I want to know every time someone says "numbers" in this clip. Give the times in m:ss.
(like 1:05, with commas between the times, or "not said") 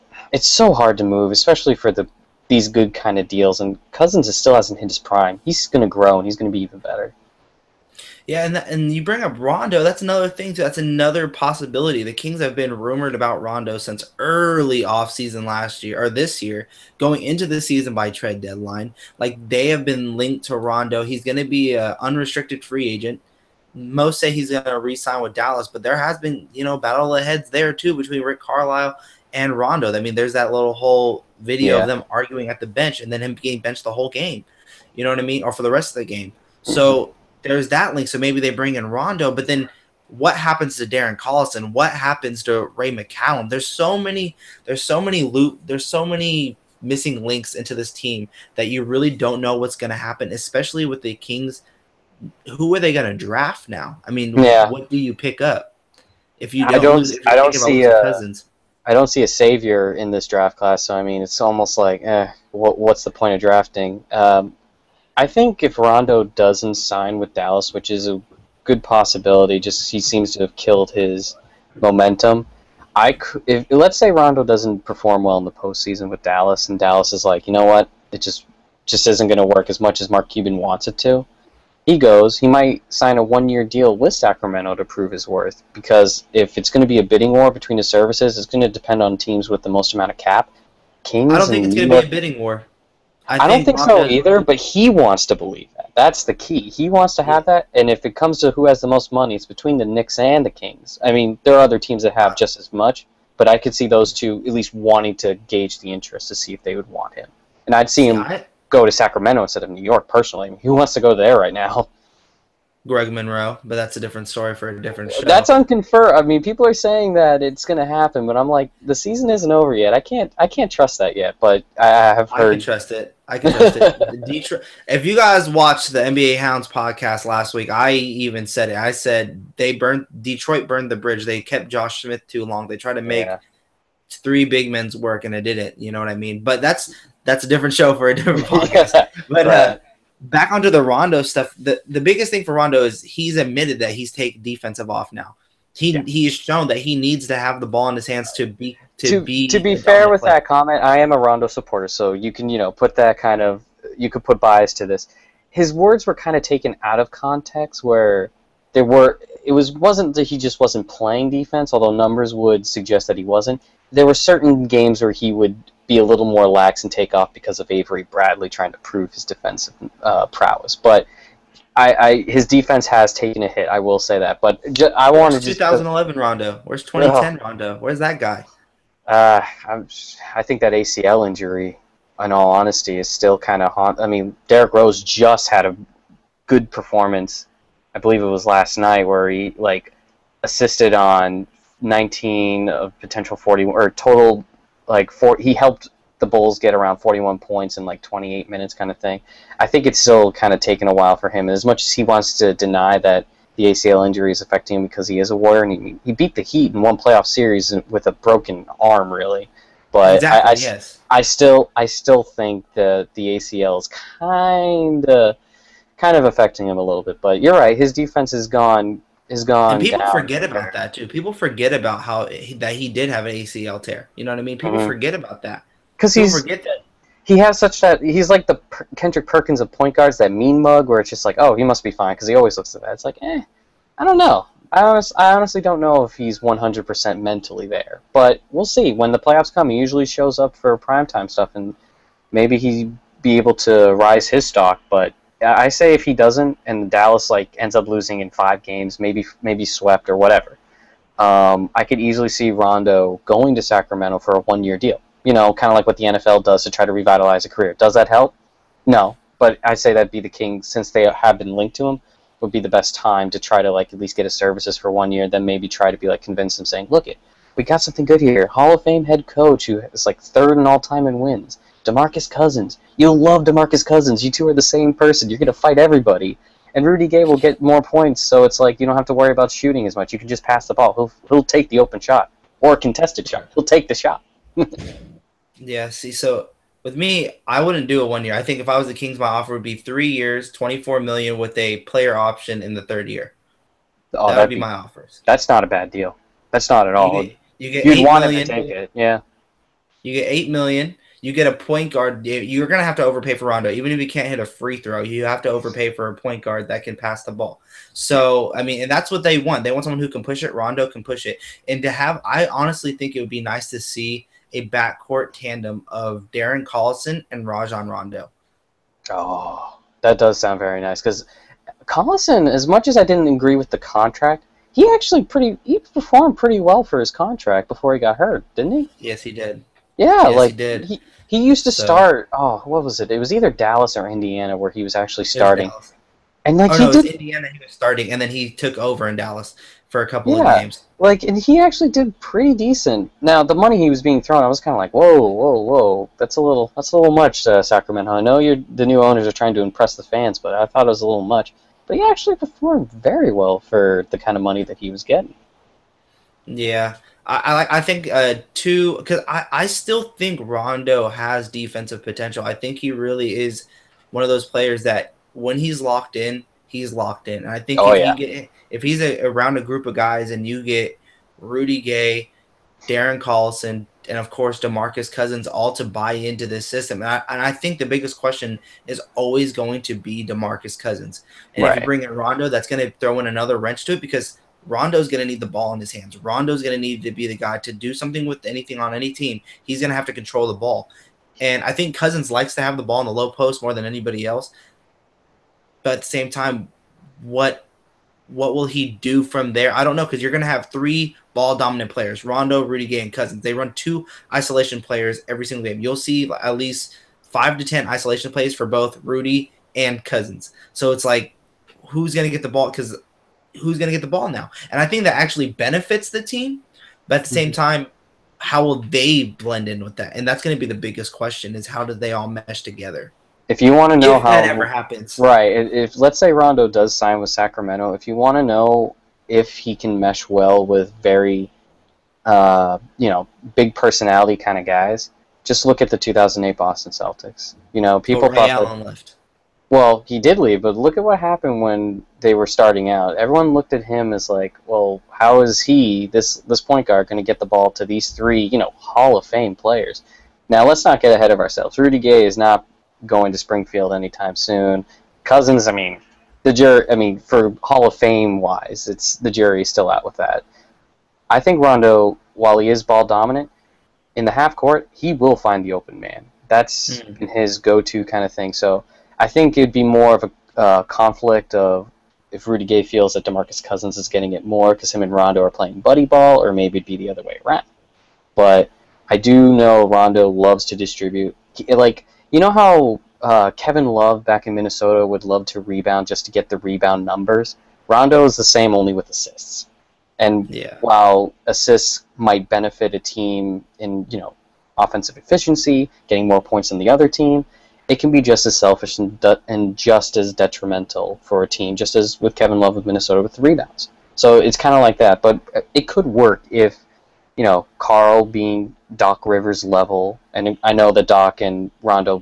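2:41, 8:07.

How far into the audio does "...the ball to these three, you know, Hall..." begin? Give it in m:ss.
7:27.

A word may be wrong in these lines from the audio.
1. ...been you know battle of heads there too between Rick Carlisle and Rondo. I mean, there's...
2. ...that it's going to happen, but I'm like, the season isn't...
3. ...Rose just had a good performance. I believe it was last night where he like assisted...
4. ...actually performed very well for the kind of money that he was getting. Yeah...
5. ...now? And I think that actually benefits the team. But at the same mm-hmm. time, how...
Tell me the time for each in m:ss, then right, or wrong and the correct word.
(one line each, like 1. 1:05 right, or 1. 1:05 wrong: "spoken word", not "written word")
1. 0:26 right
2. 1:57 right
3. 3:04 right
4. 5:52 right
5. 6:54 right.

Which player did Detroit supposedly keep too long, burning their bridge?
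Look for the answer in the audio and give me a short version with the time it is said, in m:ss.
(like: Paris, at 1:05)
Josh Smith, at 2:11.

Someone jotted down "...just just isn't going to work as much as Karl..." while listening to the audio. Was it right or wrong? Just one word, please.
wrong.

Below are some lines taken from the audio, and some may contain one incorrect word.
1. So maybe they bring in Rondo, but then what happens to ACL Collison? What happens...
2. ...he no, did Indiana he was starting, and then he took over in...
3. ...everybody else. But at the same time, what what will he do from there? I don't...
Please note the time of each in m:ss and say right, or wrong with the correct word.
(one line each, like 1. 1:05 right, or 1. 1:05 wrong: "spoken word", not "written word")
1. 0:38 wrong: "Darren", not "ACL"
2. 5:36 right
3. 6:33 wrong: "anybody", not "everybody".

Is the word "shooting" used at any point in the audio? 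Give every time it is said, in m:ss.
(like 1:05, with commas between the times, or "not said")
4:39.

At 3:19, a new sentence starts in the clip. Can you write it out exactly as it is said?
I think it's still kind of taken a while for him.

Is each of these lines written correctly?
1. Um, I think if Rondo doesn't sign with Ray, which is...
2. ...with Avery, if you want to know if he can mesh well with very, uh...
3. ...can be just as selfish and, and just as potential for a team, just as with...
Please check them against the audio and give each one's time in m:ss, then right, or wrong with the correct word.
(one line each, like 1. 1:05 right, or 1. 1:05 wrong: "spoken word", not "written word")
1. 1:04 wrong: "Dallas", not "Ray"
2. 7:07 wrong: "Sacramento", not "Avery"
3. 8:17 wrong: "detrimental", not "potential".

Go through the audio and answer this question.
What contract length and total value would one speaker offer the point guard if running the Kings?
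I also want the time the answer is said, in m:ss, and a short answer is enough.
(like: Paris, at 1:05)
3 years, $24 million, at 4:49.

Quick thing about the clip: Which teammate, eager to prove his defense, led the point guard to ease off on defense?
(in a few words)
Avery Bradley.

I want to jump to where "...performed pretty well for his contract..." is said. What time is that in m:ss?
5:25.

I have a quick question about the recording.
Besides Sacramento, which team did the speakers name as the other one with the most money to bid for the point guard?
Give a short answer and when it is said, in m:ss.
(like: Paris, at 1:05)
Knicks, at 1:39.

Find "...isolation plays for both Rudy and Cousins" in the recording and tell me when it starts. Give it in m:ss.
6:47.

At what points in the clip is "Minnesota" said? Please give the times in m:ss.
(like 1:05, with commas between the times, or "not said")
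8:04, 8:22.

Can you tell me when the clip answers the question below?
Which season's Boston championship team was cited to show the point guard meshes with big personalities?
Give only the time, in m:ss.
7:15.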